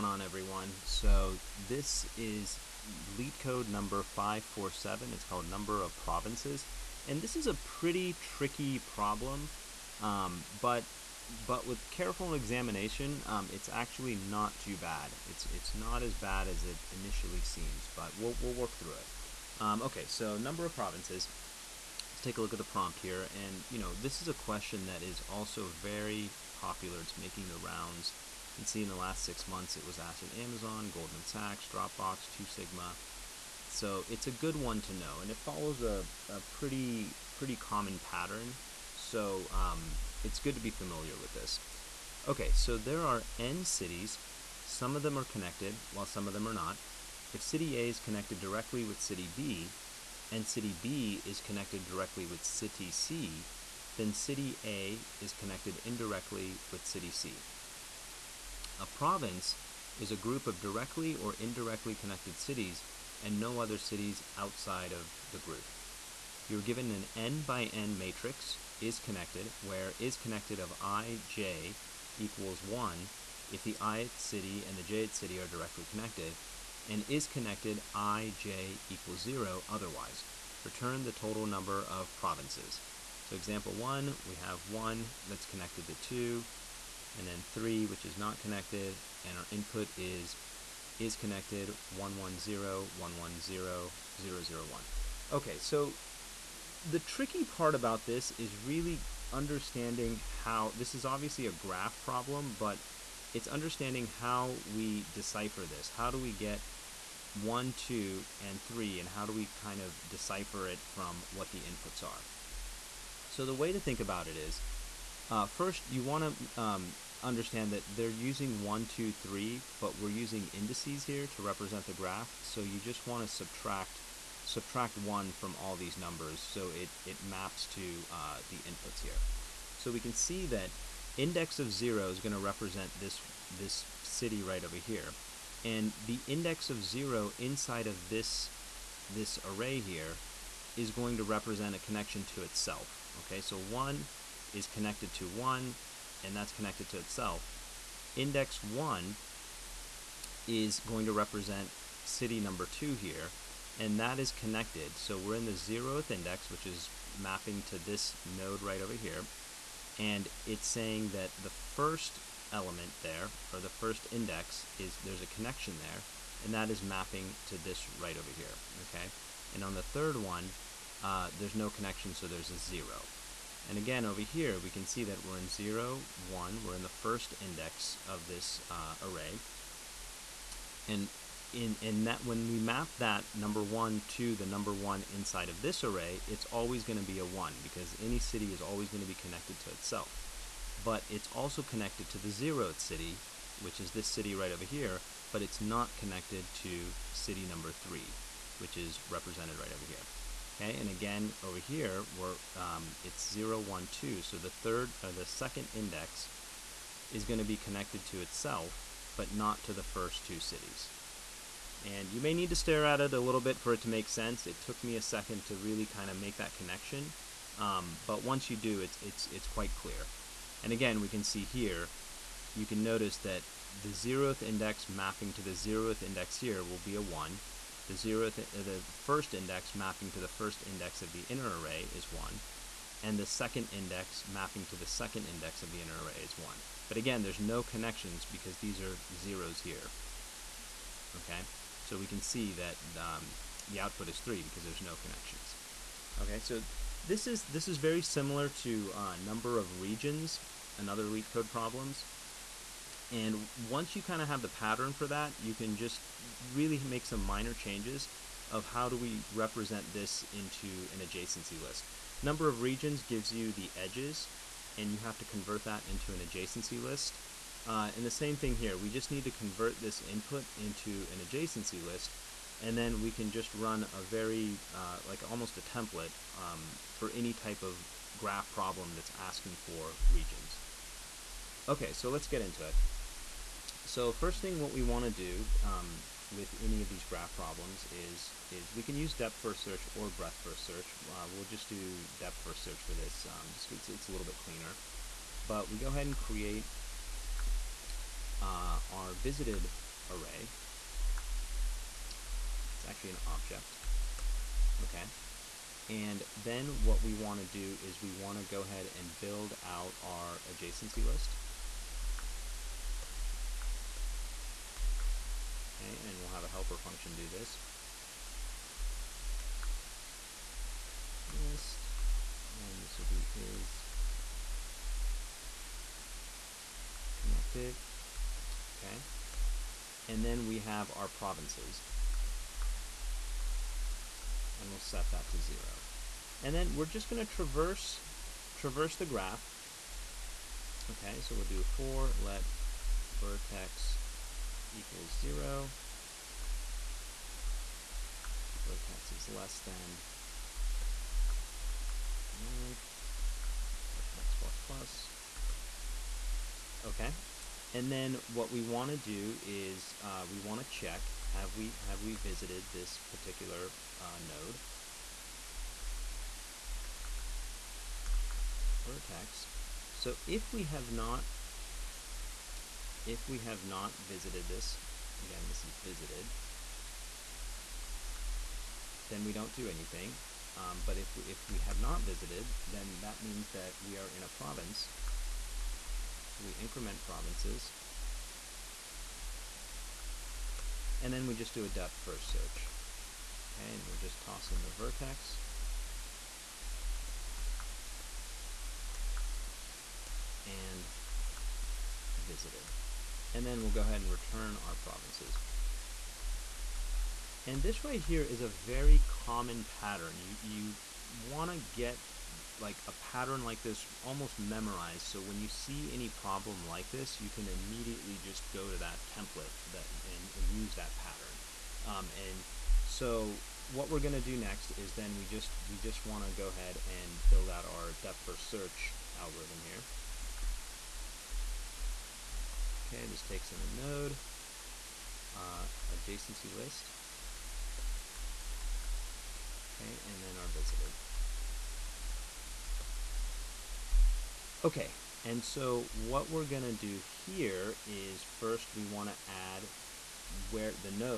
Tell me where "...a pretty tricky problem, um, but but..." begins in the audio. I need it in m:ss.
0:07.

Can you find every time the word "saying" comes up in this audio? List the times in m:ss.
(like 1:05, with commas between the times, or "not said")
2:40.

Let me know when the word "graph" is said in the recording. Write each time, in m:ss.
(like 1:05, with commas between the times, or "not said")
1:41, 2:01, 4:38, 4:47, 5:39.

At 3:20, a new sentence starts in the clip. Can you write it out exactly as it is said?
Okay, and again over here we're um, it's 0, 1, 2.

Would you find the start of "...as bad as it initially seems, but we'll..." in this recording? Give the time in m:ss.
0:16.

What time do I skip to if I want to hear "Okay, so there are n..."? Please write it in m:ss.
0:42.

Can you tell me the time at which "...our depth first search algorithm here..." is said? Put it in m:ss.
7:07.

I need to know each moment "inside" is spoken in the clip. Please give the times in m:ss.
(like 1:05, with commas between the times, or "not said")
2:17, 3:05.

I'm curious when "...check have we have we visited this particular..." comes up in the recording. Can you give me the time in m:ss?
6:00.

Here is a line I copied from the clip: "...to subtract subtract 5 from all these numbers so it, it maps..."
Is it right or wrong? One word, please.
wrong.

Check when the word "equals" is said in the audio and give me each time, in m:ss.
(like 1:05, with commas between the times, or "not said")
1:12, 1:18, 5:44.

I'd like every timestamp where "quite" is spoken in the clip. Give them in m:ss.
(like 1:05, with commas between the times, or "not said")
3:39.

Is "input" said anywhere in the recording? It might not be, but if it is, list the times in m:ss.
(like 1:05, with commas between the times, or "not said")
1:29, 1:51, 2:08, 4:30.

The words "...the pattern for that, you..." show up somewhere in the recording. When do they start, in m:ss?
4:14.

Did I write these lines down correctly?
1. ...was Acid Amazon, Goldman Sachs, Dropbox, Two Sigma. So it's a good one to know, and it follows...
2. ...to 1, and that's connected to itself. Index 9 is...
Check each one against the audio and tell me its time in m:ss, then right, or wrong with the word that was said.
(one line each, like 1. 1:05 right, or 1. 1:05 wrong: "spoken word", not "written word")
1. 0:29 right
2. 2:25 wrong: "1", not "9".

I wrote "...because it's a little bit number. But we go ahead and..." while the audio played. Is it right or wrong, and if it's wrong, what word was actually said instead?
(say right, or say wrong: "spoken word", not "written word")
wrong: "cleaner", not "number".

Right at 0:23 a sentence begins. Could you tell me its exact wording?
And, you know, this is a question that is also very popular.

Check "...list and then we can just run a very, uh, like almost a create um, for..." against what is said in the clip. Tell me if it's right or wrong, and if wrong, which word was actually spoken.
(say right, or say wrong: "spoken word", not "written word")
wrong: "template", not "create".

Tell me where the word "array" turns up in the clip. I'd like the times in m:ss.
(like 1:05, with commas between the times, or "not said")
2:19, 2:59, 3:05, 3:51, 3:56, 5:00.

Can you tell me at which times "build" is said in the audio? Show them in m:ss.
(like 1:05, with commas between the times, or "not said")
5:09, 7:07.